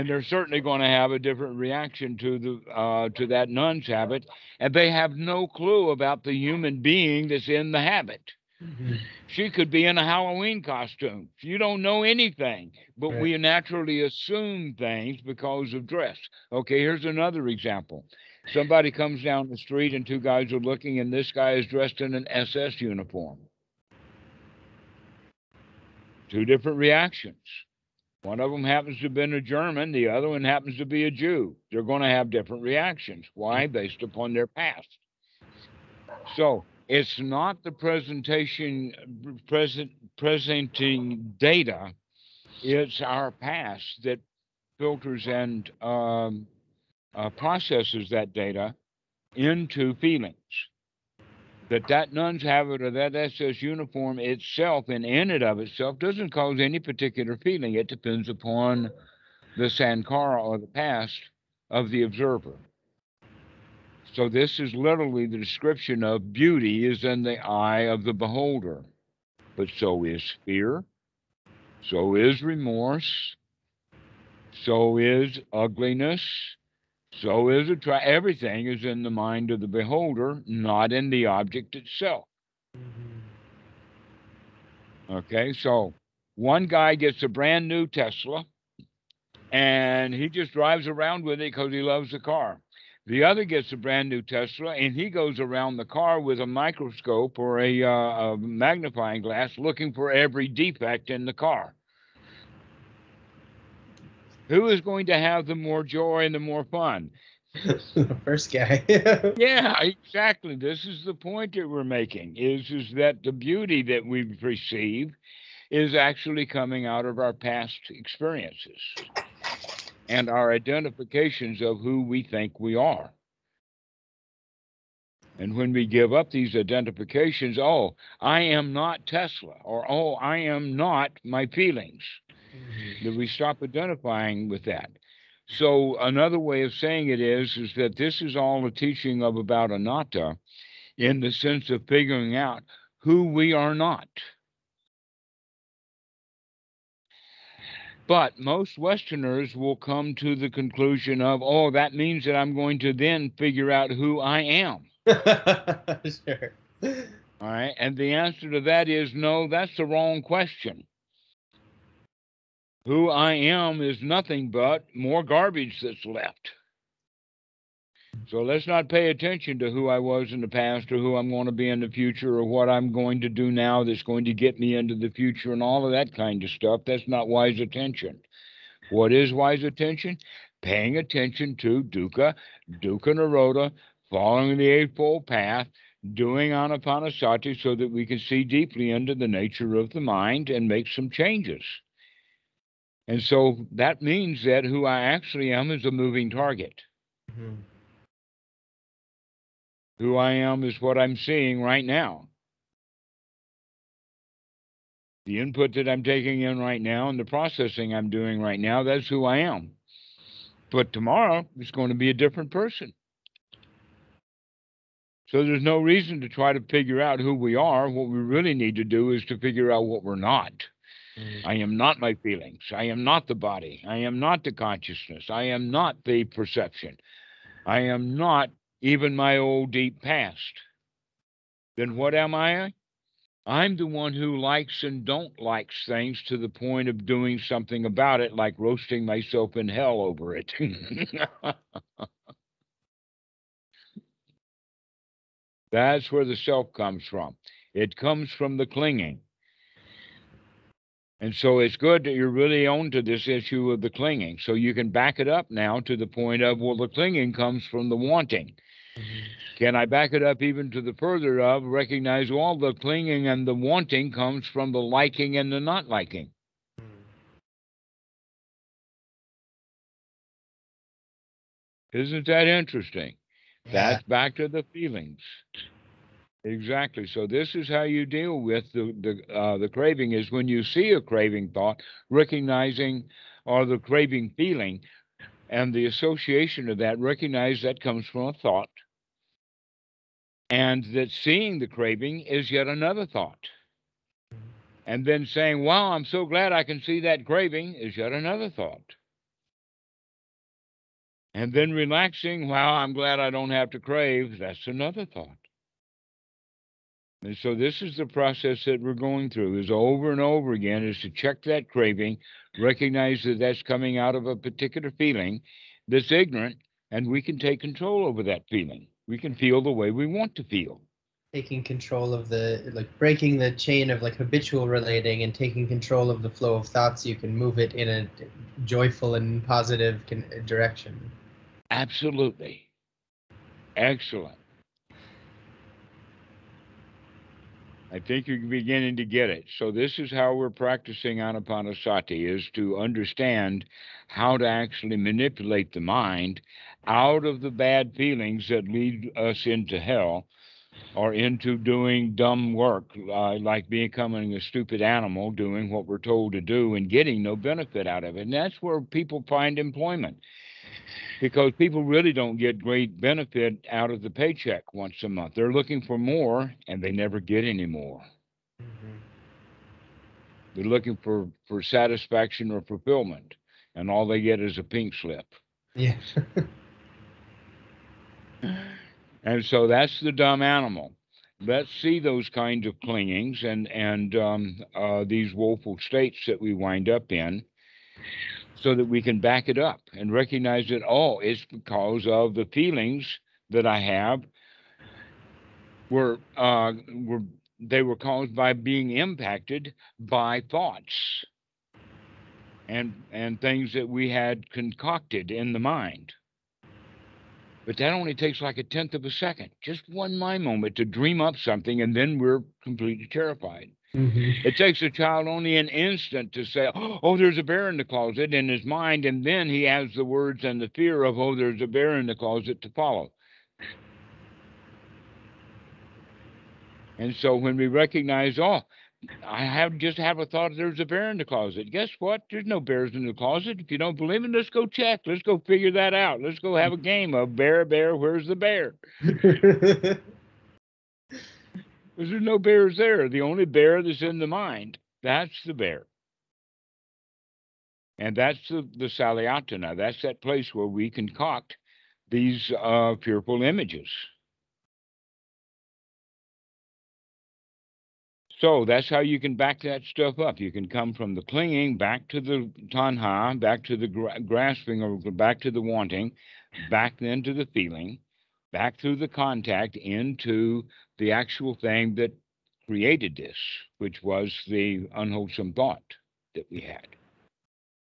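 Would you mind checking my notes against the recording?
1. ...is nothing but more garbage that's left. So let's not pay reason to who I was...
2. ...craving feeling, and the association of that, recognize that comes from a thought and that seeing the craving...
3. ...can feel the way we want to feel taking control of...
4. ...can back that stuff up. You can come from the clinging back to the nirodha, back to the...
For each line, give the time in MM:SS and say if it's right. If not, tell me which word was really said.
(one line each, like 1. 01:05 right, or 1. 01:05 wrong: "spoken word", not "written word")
1. 02:43 wrong: "attention", not "reason"
2. 04:43 right
3. 05:19 right
4. 07:39 wrong: "tanha", not "nirodha".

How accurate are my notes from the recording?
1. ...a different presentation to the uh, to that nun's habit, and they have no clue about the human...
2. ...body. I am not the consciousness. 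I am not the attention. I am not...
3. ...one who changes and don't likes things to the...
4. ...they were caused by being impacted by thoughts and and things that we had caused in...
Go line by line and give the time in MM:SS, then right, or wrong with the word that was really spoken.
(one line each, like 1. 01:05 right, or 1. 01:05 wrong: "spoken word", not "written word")
1. 00:01 wrong: "reaction", not "presentation"
2. 03:43 wrong: "perception", not "attention"
3. 03:53 wrong: "likes", not "changes"
4. 06:37 wrong: "concocted", not "caused".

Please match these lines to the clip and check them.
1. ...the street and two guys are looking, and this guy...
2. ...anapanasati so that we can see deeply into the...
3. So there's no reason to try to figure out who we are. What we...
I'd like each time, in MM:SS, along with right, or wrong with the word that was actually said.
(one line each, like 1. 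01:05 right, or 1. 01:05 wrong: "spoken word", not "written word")
1. 00:19 right
2. 03:06 right
3. 03:35 right.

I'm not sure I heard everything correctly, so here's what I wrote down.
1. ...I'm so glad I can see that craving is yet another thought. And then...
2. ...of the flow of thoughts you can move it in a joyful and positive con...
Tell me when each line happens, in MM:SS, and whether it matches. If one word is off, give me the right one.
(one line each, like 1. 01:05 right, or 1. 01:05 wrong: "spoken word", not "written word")
1. 04:55 right
2. 05:26 right.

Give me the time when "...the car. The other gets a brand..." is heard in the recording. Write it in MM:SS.
01:32.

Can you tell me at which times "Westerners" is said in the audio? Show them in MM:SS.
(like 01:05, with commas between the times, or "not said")
02:28.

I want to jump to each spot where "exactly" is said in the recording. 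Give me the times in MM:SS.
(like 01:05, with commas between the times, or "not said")
01:49, 04:36.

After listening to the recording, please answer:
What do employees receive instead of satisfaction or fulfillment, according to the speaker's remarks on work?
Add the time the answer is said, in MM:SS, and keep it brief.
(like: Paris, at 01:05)
a pink slip, at 06:14.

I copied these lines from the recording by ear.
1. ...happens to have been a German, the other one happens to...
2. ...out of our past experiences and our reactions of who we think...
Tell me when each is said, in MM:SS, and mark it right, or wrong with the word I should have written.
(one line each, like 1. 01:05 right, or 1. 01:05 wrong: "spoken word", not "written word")
1. 00:28 right
2. 01:56 wrong: "identifications", not "reactions".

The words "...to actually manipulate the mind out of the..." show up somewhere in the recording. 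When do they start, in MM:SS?
05:44.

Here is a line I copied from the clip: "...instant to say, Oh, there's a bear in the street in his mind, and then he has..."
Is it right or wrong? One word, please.
wrong.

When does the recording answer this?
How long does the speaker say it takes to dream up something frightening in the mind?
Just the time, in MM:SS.
06:48.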